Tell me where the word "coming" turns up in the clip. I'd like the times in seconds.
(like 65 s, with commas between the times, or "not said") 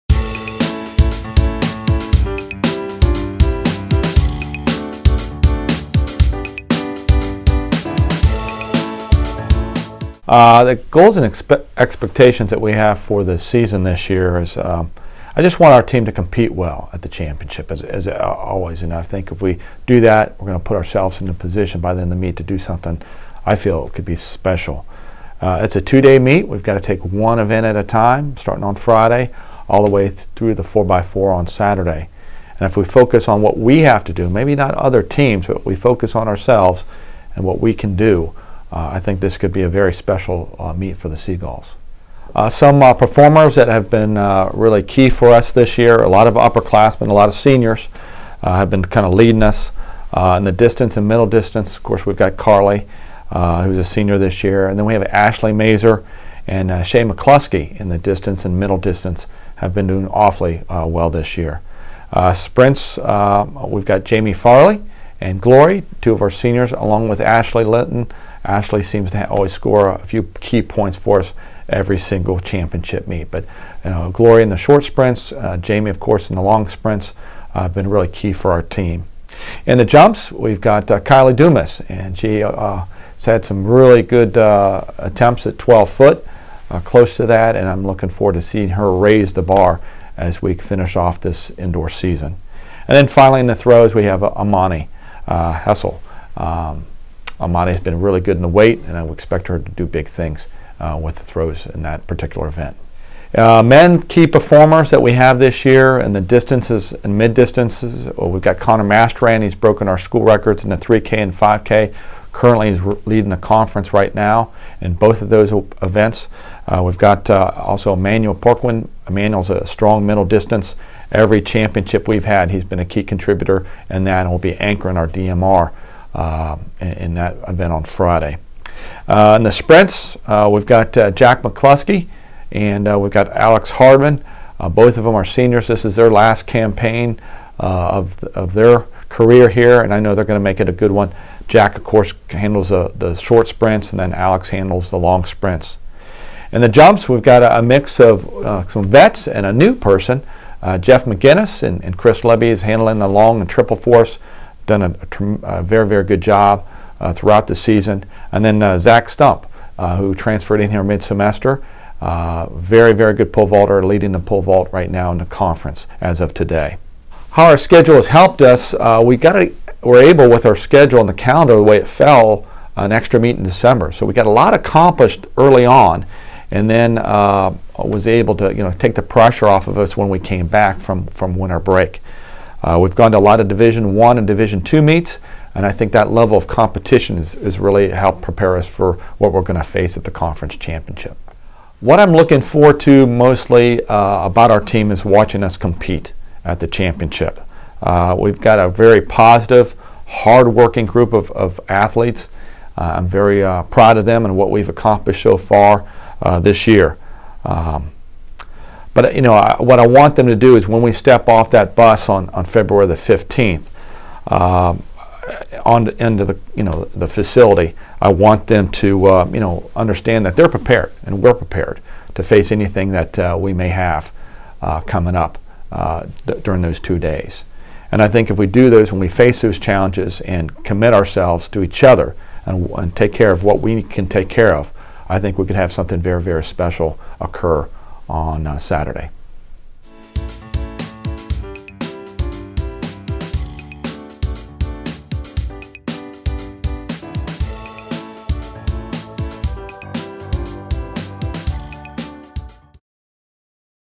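224 s.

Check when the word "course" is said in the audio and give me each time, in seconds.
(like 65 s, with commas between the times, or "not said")
51 s, 75 s, 141 s.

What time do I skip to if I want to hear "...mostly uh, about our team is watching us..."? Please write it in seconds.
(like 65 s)
193 s.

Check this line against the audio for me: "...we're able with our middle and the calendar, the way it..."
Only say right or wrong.
wrong.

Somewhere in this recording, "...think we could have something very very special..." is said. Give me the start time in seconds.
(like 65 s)
235 s.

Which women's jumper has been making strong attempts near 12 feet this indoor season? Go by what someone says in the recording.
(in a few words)
Kylie Dumas.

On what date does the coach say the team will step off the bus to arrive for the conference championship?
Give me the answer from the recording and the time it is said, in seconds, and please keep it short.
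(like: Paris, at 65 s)
February 15, at 212 s.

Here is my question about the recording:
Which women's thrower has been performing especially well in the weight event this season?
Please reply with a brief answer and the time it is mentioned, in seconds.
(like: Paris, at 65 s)
Amani Hessel, at 94 s.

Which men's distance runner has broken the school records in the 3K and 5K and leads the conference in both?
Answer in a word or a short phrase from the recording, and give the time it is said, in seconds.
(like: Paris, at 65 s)
Connor Mastran, at 108 s.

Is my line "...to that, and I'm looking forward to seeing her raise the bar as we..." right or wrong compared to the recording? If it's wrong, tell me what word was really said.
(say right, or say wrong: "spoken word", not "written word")
right.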